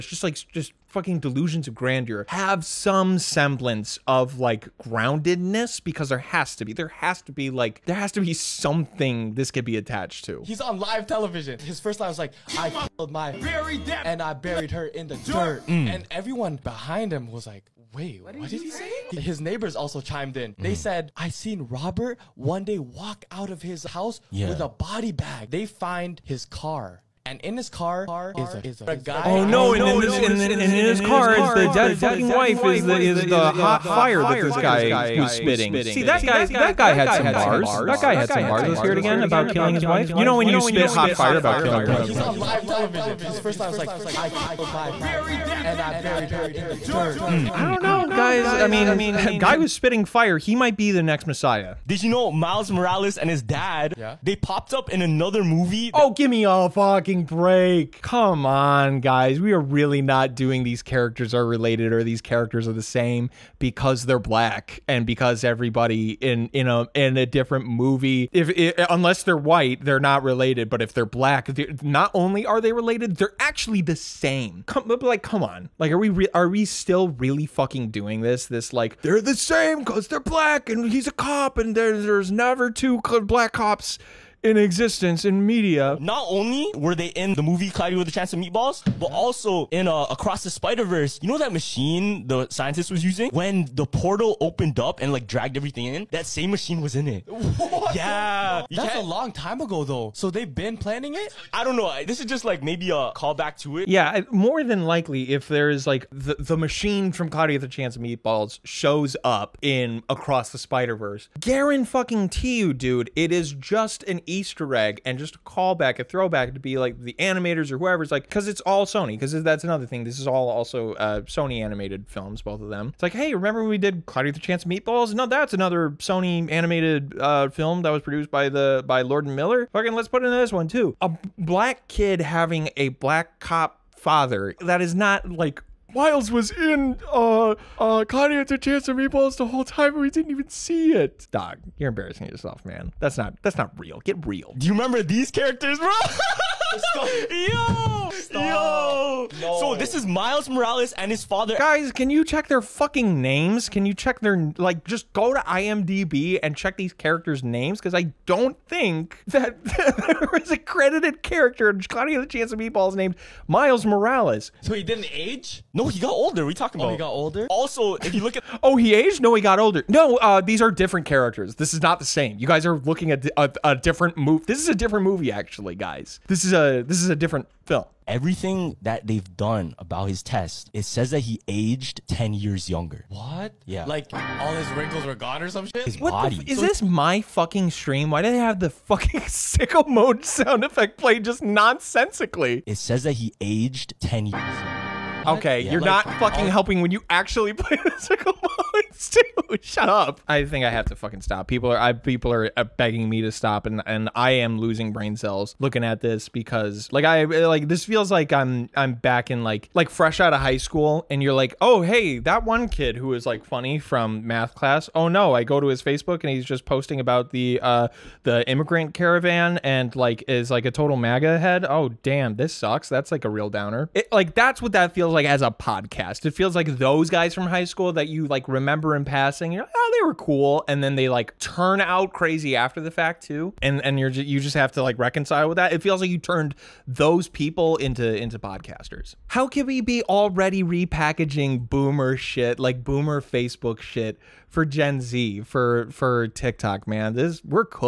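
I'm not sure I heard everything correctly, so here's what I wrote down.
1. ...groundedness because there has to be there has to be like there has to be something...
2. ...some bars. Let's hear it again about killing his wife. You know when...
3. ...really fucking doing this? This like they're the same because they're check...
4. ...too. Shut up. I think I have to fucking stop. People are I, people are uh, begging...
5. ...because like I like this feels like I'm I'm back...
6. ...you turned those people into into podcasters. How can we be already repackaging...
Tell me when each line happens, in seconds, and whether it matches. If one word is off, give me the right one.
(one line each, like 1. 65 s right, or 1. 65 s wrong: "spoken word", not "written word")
1. 4 s right
2. 38 s right
3. 77 s wrong: "black", not "check"
4. 199 s right
5. 206 s right
6. 236 s right.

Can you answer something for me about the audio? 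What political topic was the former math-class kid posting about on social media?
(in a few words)
The immigrant caravan.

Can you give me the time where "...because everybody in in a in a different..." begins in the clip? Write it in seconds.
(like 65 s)
65 s.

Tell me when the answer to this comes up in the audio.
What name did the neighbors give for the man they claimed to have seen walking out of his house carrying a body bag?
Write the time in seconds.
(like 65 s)
21 s.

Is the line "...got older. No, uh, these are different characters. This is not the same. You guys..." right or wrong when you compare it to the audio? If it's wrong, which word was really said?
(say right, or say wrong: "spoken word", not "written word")
right.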